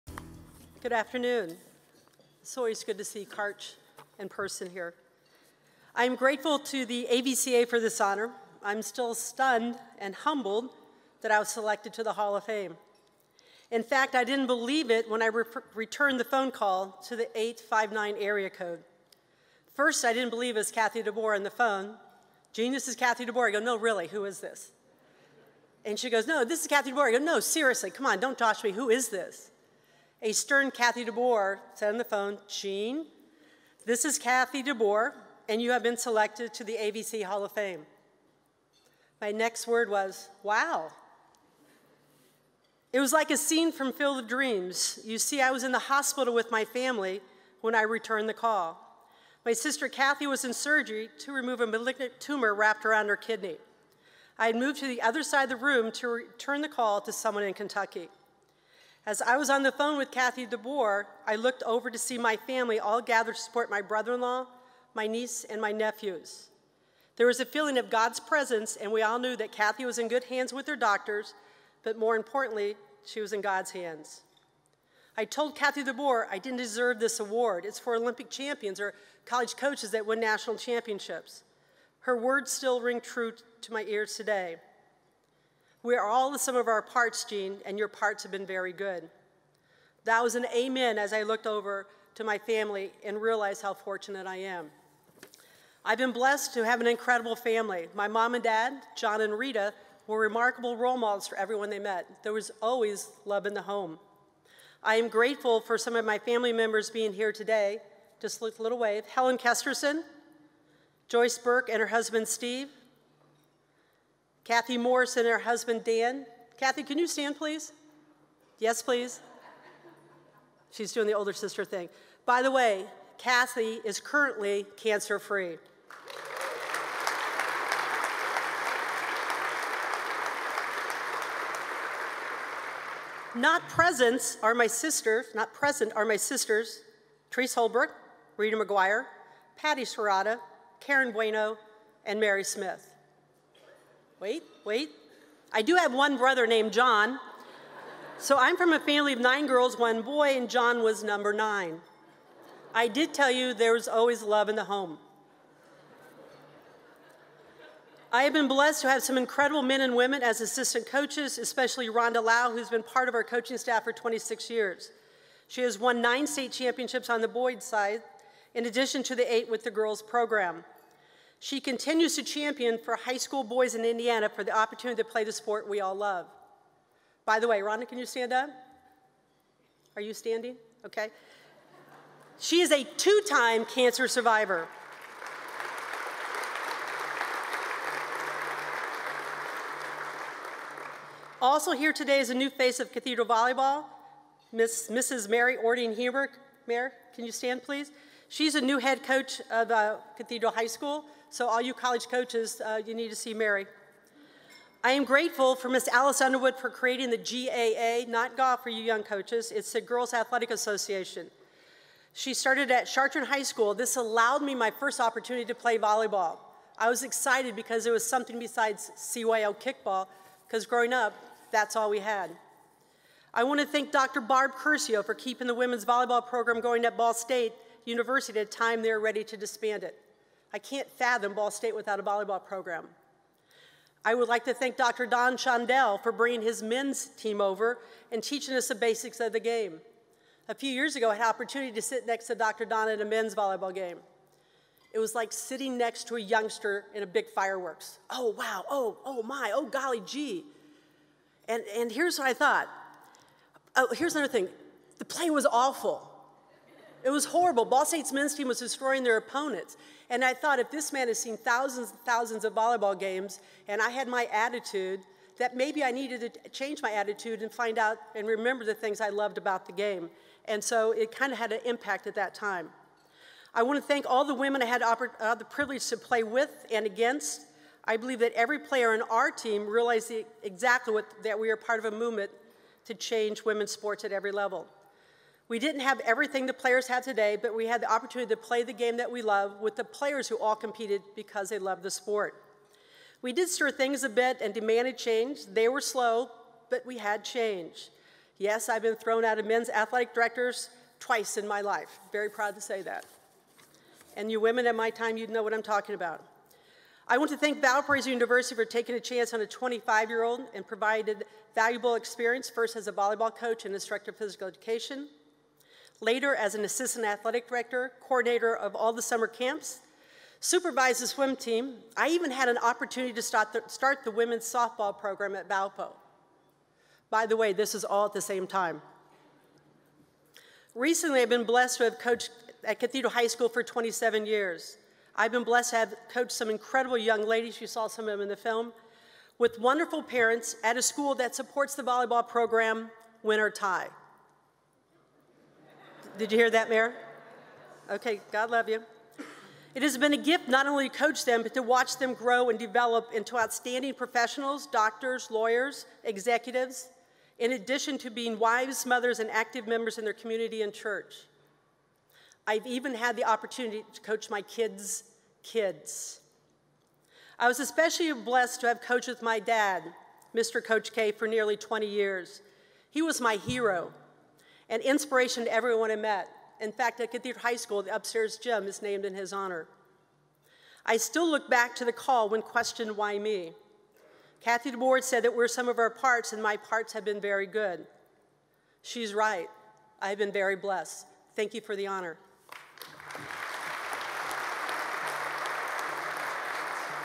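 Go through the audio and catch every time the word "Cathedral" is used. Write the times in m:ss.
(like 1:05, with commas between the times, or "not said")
3:12, 3:20, 5:32, 6:17.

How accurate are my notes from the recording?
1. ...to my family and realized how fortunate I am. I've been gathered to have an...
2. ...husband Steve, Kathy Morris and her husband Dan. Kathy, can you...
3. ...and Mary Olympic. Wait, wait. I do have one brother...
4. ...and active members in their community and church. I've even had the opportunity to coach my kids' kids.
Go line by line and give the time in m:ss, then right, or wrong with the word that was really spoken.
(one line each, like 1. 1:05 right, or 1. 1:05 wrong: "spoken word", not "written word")
1. 1:32 wrong: "blessed", not "gathered"
2. 1:51 right
3. 2:22 wrong: "Smith", not "Olympic"
4. 5:59 right.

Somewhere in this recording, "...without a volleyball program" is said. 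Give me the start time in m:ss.
3:51.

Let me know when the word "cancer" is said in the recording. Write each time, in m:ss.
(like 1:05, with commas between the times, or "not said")
2:04, 3:03.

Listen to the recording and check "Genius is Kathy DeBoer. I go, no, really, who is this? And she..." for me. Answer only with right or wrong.
right.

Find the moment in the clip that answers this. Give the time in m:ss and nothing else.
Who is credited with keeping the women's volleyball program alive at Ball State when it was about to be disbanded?
3:43.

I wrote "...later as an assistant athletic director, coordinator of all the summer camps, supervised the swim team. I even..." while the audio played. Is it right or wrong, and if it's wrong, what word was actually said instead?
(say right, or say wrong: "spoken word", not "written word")
right.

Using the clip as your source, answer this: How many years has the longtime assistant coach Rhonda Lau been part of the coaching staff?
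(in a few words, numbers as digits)
26.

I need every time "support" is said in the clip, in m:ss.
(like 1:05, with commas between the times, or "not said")
1:03, 5:41.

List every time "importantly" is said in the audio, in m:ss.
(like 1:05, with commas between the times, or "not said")
1:12.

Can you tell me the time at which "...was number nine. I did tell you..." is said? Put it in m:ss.
2:30.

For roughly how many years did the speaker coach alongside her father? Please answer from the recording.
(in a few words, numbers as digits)
20.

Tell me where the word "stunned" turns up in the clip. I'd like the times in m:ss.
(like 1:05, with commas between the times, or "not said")
0:09.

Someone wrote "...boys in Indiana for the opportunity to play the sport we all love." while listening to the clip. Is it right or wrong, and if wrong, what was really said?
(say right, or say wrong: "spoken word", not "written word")
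right.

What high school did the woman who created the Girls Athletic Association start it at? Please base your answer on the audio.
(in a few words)
Chartres High School.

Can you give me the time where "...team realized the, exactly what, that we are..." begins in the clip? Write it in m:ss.
4:39.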